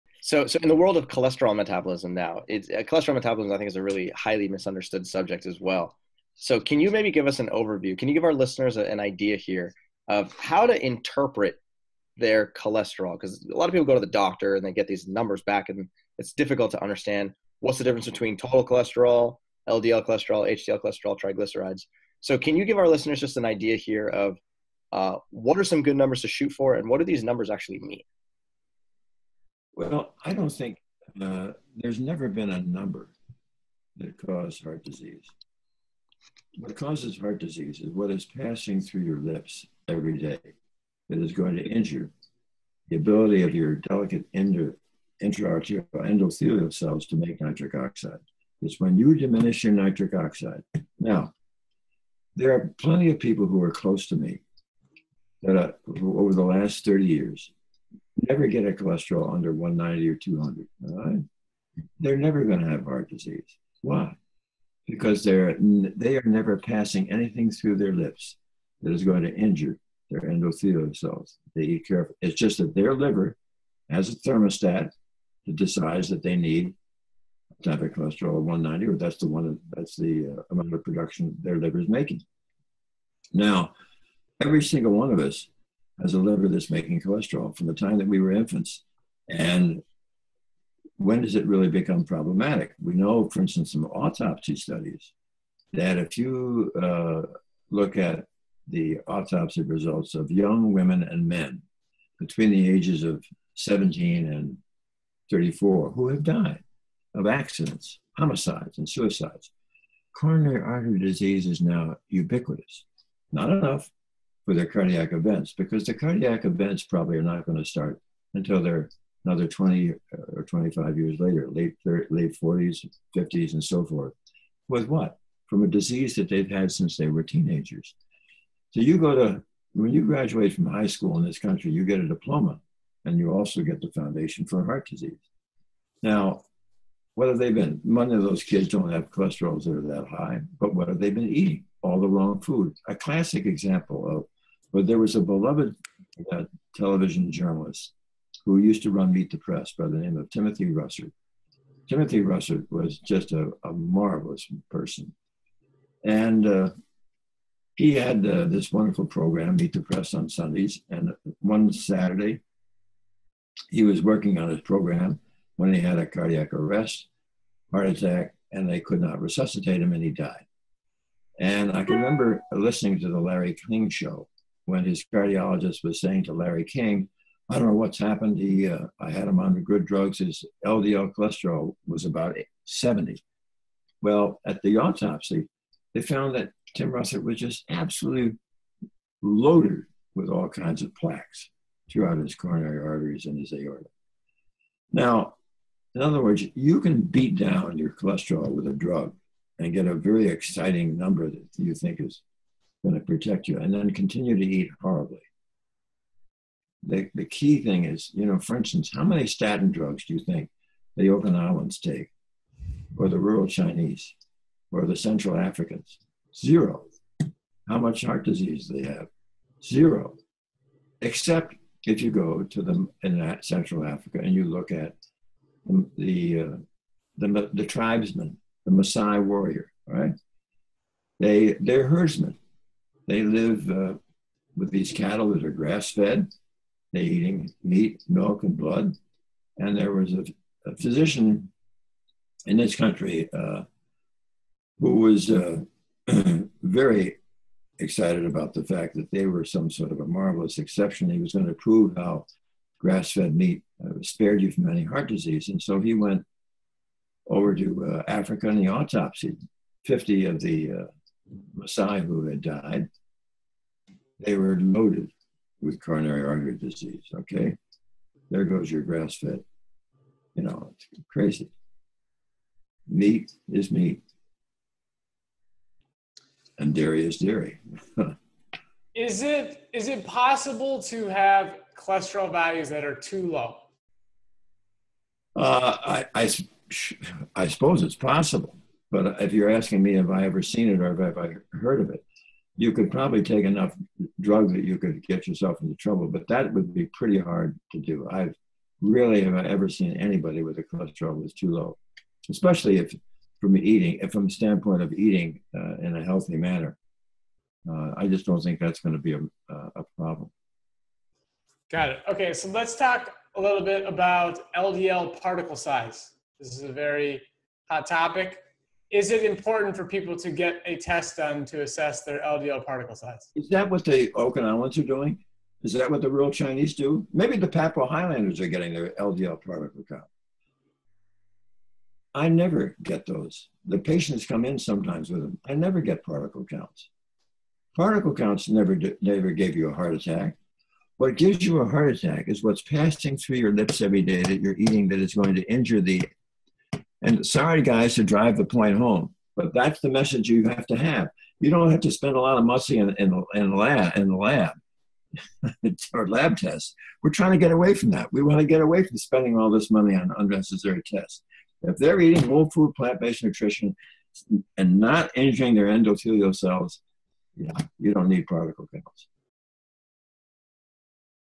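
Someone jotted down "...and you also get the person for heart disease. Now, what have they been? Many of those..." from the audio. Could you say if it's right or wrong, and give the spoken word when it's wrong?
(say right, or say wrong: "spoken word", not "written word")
wrong: "foundation", not "person".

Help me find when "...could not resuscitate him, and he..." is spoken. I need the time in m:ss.
2:48.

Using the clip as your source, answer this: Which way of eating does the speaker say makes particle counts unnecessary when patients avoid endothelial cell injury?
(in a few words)
Whole food, plant-based nutrition.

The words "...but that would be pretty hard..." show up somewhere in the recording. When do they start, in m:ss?
4:56.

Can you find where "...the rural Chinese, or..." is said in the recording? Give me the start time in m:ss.
3:33.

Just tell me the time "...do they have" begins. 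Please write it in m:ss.
3:38.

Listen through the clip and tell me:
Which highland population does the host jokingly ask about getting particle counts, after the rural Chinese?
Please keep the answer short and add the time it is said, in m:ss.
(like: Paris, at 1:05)
Papua Highlanders, at 5:27.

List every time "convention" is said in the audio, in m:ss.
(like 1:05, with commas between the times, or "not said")
not said.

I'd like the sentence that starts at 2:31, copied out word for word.
Timothy Russert was just a, a marvelous person.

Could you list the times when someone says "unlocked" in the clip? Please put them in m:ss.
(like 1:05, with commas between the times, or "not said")
not said.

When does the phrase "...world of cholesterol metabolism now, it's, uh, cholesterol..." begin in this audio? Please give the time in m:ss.
0:00.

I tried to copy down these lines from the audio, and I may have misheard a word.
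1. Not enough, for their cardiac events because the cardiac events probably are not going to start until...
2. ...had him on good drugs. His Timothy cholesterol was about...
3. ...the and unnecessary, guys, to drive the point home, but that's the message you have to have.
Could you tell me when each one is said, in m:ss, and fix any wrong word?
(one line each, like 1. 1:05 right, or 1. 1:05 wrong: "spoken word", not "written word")
1. 1:53 right
2. 2:59 wrong: "LDL", not "Timothy"
3. 5:45 wrong: "sorry", not "unnecessary".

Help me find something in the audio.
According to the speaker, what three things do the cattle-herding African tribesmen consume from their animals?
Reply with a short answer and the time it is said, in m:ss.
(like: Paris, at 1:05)
Meat, milk, and blood, at 3:57.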